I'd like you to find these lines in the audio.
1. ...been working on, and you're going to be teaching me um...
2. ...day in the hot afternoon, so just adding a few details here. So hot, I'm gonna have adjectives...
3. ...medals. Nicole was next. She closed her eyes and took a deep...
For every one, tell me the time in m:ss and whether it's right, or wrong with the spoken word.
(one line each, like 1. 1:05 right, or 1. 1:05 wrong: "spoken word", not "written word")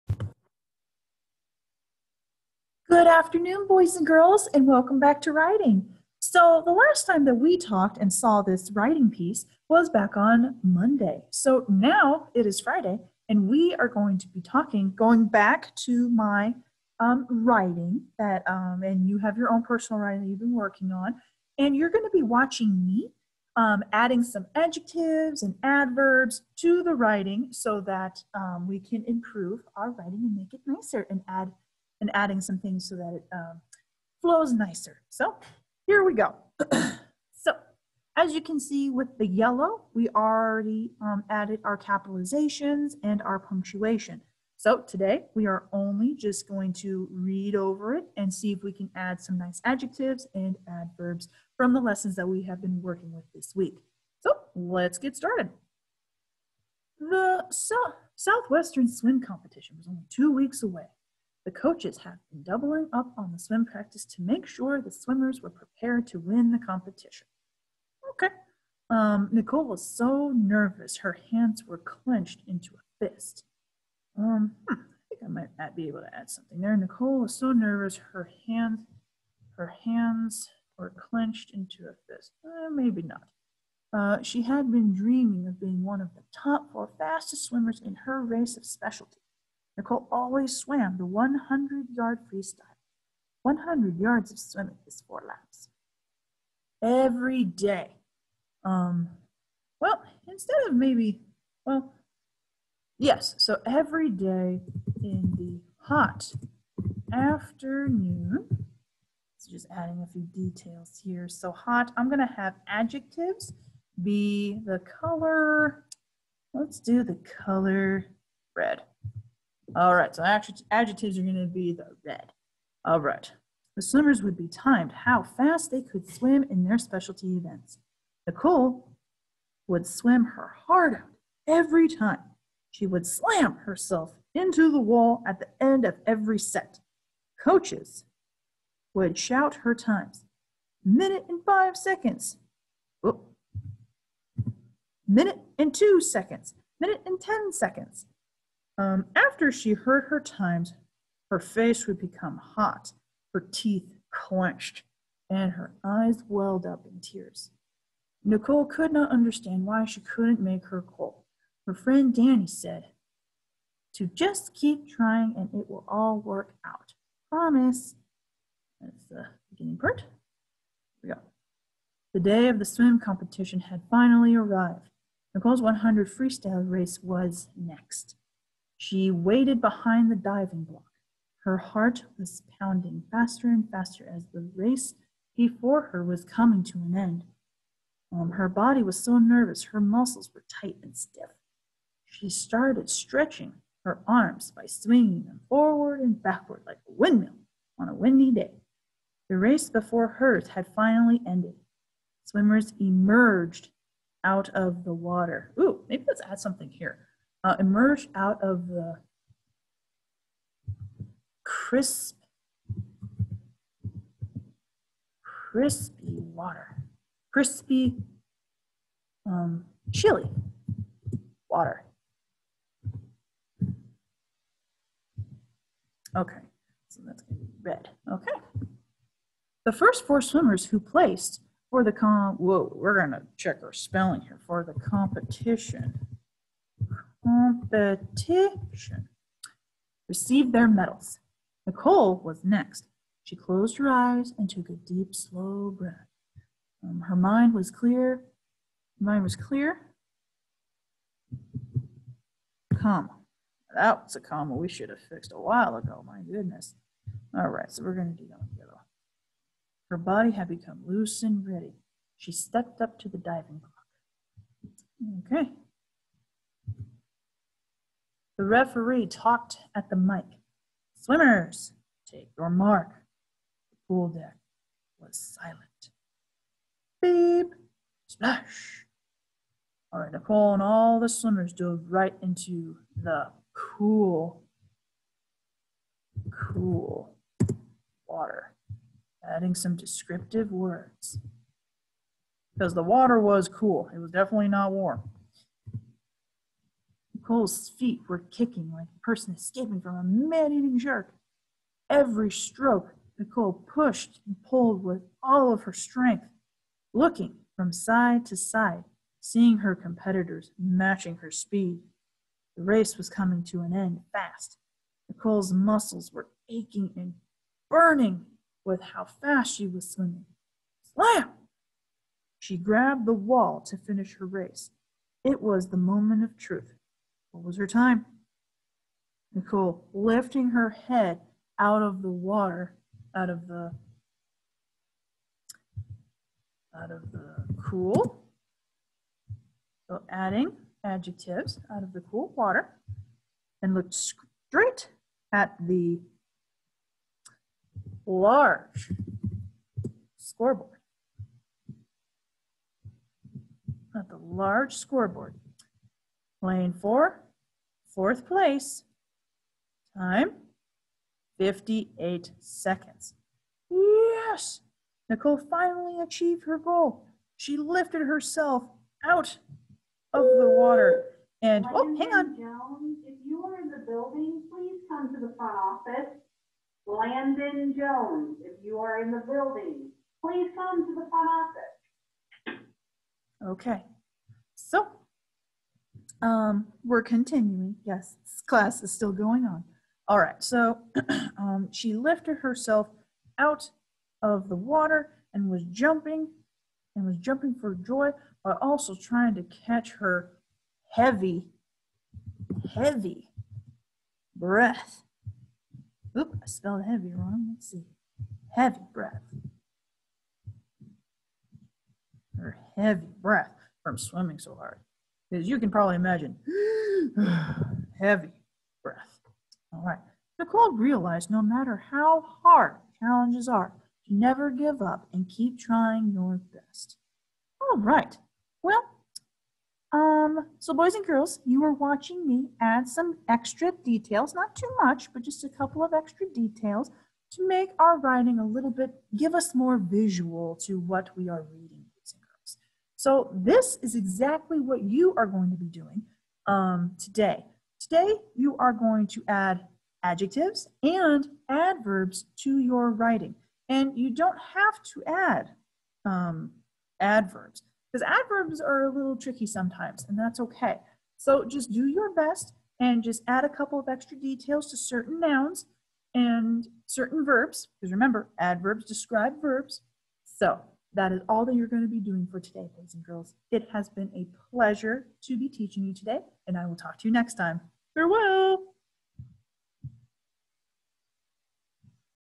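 1. 0:20 wrong: "watching", not "teaching"
2. 1:44 right
3. 4:00 right.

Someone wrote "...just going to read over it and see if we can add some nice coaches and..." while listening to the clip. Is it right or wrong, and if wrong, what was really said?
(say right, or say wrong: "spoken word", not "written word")
wrong: "adjectives", not "coaches".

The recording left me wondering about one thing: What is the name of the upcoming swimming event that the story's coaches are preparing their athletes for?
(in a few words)
Southwestern Swim Competition.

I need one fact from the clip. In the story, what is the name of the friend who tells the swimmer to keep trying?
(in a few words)
Danny.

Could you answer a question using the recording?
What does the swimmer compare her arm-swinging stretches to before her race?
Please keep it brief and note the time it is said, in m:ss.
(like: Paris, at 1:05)
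a windmill, at 3:16.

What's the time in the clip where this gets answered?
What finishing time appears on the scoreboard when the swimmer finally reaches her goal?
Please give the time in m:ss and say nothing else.
6:01.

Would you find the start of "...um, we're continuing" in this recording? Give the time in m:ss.
6:26.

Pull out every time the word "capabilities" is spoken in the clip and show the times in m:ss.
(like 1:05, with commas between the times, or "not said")
not said.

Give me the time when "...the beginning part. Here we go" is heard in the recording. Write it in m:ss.
2:49.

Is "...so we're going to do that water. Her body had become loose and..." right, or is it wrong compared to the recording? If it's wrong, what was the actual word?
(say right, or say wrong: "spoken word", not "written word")
wrong: "together", not "water".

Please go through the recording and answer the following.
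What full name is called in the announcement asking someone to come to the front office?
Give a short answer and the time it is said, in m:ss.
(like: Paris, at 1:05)
Landon Jones, at 6:16.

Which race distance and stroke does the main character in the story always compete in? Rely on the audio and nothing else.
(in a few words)
100 yard freestyle.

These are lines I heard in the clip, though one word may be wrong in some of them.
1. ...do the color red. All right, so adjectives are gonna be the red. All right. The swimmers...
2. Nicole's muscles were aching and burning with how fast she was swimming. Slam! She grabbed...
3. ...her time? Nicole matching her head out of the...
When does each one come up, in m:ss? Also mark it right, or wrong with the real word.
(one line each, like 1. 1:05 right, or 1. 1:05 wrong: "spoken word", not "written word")
1. 1:56 right
2. 5:15 right
3. 5:27 wrong: "lifting", not "matching".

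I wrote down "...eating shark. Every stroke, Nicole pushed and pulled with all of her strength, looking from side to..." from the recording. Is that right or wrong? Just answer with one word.
right.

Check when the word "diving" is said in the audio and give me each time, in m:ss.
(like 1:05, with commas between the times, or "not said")
3:00, 4:23.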